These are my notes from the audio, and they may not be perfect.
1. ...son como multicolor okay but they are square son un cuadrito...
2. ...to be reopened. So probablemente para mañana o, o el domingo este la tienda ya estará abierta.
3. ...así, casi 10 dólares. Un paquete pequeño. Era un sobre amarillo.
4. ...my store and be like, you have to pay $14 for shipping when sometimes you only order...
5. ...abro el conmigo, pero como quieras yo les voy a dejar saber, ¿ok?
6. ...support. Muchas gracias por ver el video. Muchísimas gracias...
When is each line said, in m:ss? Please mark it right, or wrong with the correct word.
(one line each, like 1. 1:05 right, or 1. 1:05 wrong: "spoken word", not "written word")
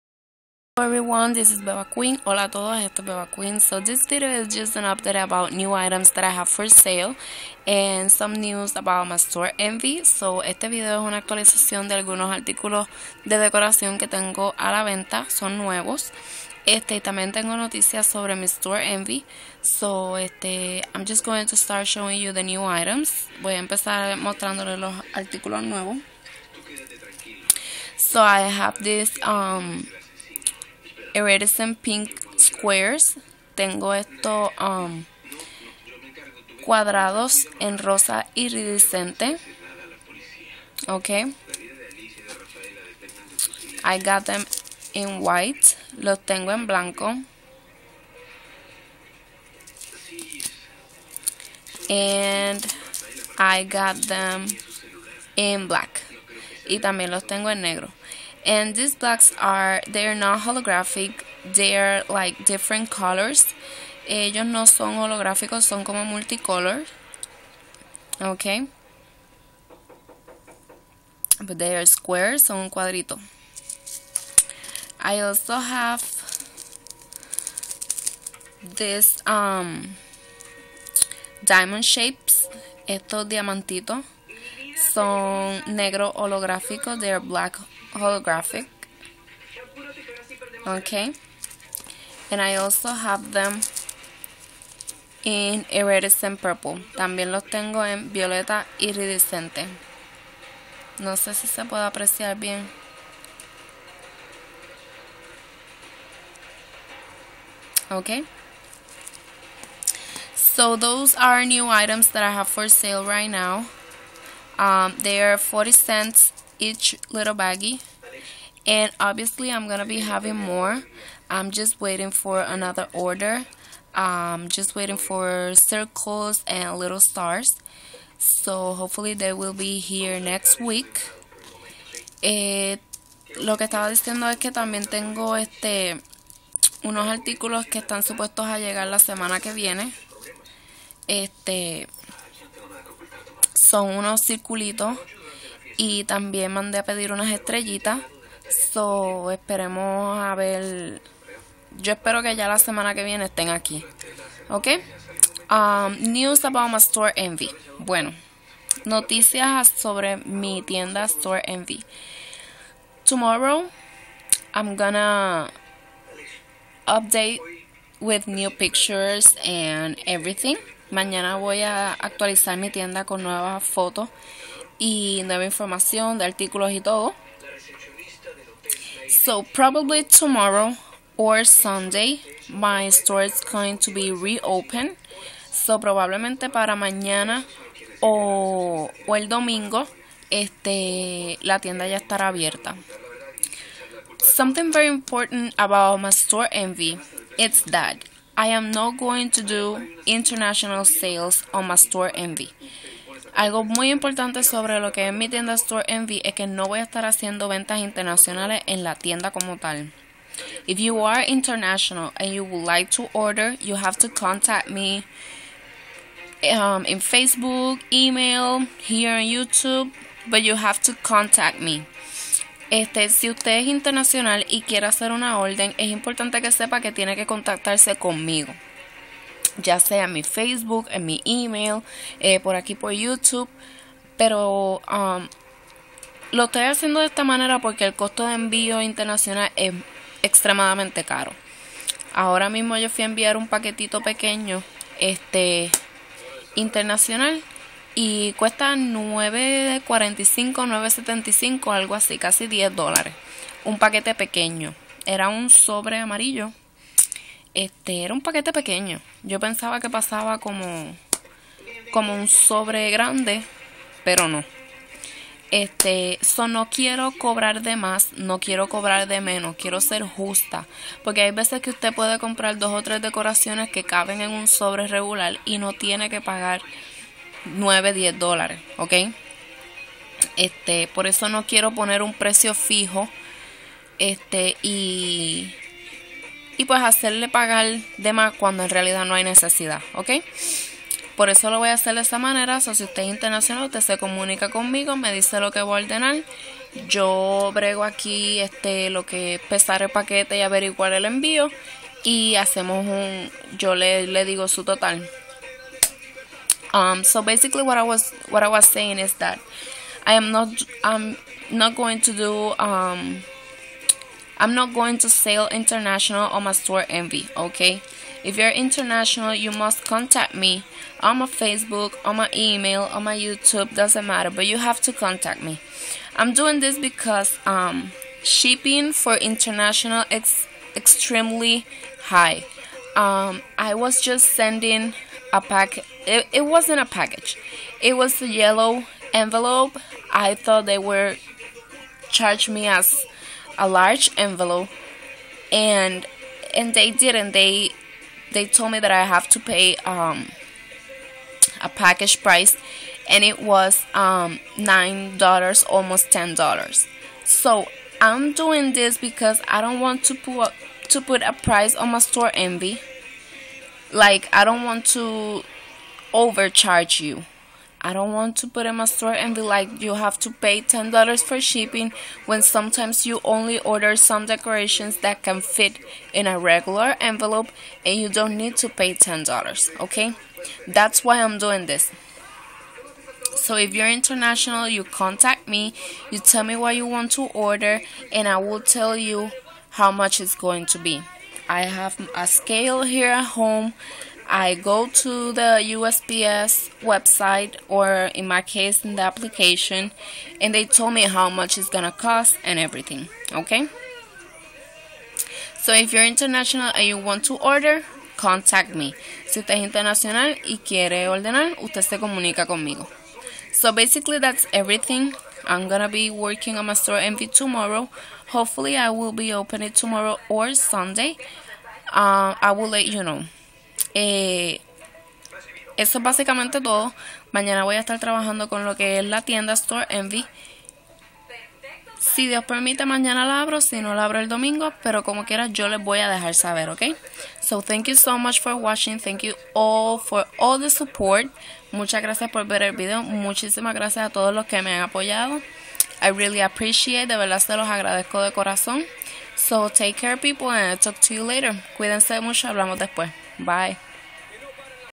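1. 1:05 right
2. 3:03 right
3. 4:11 right
4. 6:08 wrong: "10", not "14"
5. 7:14 wrong: "domingo", not "conmigo"
6. 7:20 right.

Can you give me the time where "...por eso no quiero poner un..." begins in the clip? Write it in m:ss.
4:40.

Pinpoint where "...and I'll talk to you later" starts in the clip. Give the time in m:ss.
7:30.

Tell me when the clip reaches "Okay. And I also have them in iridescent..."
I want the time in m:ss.
1:30.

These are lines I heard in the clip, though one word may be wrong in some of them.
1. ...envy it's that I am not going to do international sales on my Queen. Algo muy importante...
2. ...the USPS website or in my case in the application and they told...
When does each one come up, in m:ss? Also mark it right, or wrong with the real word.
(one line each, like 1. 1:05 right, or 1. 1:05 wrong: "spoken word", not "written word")
1. 3:16 wrong: "Storenvy", not "Queen"
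2. 6:35 right.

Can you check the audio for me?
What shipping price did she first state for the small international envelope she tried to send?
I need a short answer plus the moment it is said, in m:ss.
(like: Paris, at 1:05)
9.45, at 4:08.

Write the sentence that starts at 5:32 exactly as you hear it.
Um, I was just sending a pack.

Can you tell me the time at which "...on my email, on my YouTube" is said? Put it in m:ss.
5:22.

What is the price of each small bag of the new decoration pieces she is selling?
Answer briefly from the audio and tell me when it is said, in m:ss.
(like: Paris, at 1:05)
40 cents, at 1:55.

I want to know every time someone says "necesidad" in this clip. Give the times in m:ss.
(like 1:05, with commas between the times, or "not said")
4:49.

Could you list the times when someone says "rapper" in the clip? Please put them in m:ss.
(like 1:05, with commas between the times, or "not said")
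not said.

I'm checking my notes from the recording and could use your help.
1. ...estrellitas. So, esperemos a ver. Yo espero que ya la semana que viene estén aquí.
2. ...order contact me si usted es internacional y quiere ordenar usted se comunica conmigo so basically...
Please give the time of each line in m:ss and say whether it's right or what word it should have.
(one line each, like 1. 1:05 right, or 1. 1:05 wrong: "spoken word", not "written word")
1. 2:27 right
2. 6:47 right.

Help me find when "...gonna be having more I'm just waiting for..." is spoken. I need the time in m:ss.
1:59.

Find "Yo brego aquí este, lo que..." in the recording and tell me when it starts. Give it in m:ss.
4:56.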